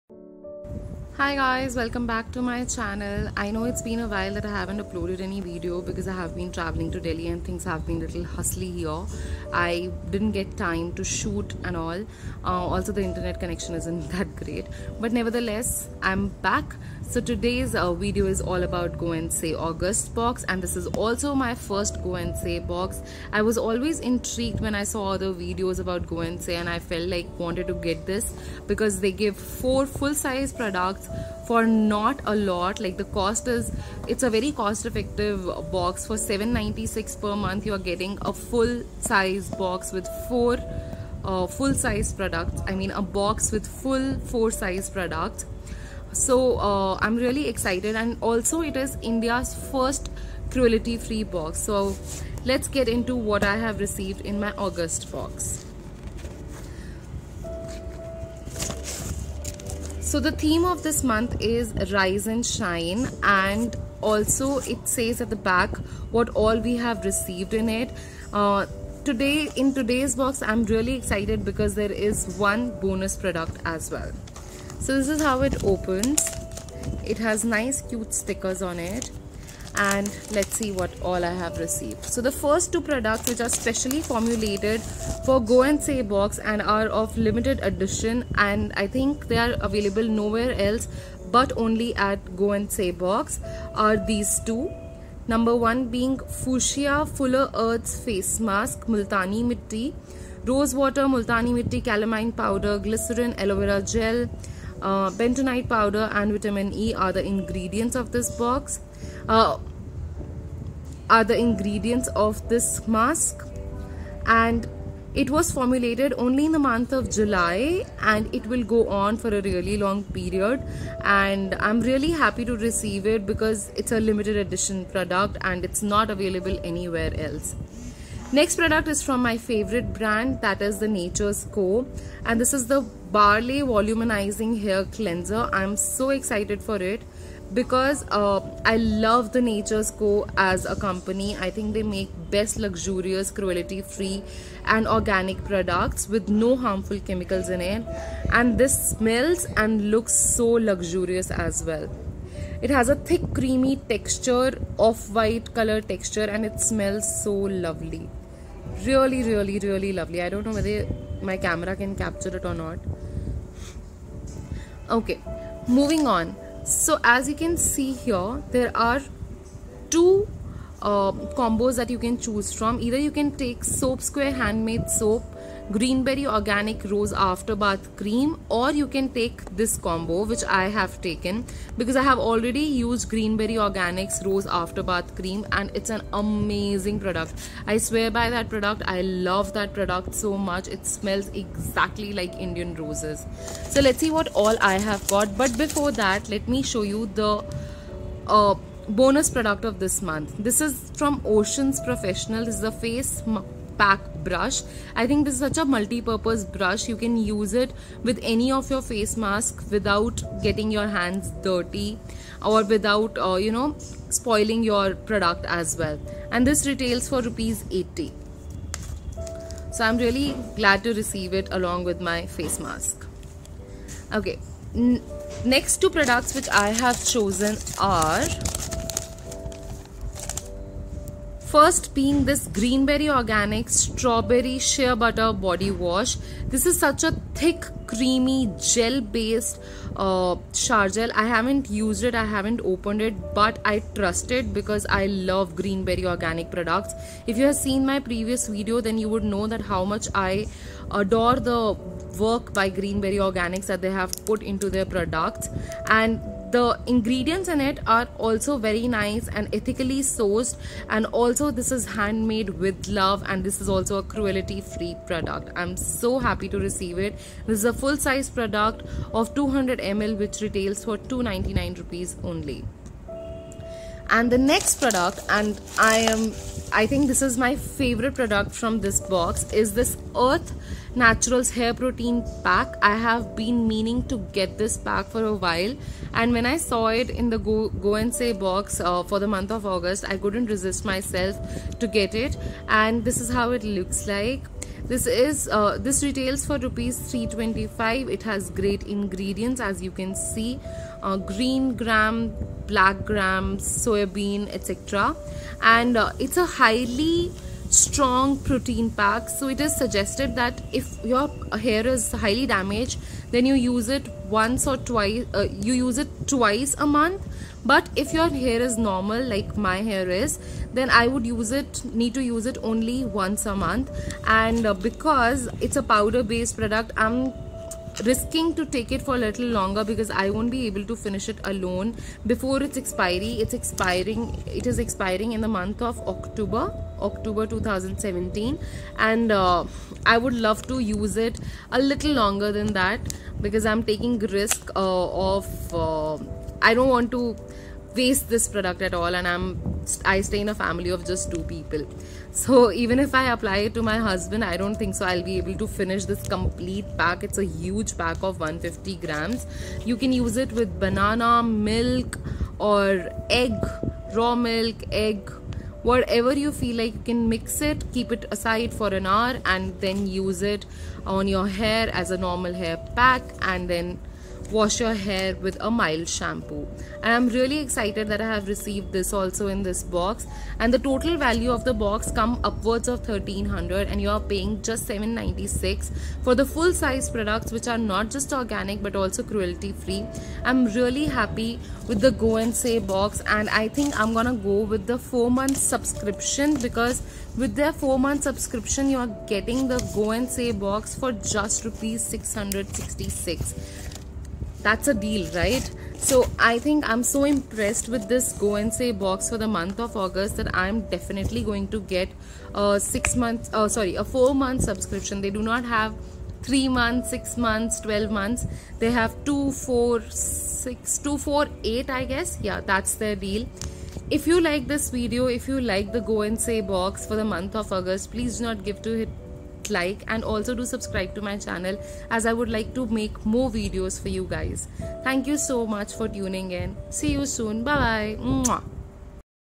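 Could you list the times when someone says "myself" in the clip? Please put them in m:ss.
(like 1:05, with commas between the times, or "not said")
4:50.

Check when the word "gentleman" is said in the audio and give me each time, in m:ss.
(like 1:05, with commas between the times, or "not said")
not said.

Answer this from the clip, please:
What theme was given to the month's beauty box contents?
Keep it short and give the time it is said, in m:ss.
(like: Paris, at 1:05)
Rise and shine, at 1:01.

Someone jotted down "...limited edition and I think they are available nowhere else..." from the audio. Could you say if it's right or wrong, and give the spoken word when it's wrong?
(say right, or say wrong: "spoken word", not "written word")
right.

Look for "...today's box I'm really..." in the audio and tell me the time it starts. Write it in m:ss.
1:09.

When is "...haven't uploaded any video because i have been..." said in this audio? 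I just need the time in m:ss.
0:04.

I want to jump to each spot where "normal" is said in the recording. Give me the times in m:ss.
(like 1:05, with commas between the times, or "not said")
5:18, 6:12.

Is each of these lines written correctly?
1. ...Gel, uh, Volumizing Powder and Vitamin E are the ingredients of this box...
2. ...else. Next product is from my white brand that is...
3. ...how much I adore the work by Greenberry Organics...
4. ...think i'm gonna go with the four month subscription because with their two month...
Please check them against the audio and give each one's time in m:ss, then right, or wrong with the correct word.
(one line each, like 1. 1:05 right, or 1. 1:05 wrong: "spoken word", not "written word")
1. 1:43 wrong: "Bentonite", not "Volumizing"
2. 2:07 wrong: "favorite", not "white"
3. 4:09 right
4. 6:33 wrong: "four", not "two".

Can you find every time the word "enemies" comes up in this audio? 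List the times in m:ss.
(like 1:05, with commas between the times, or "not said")
not said.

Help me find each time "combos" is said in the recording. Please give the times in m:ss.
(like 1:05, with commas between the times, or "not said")
2:51, 2:59.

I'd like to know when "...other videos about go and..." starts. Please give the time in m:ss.
0:25.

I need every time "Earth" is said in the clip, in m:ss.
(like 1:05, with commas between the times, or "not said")
1:37, 4:40.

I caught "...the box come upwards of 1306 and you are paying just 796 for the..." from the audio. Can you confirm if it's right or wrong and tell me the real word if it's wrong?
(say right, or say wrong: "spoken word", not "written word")
wrong: "1300", not "1306".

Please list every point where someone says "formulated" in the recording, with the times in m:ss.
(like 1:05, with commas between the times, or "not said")
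1:24, 1:55.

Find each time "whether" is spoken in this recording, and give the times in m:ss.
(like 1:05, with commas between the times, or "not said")
2:40.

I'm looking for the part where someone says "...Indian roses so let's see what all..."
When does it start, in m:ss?
3:12.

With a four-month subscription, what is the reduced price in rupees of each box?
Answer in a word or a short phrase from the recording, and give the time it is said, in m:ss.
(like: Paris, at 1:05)
666, at 6:41.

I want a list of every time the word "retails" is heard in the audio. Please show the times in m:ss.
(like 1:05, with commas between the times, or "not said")
3:36, 4:30, 4:56.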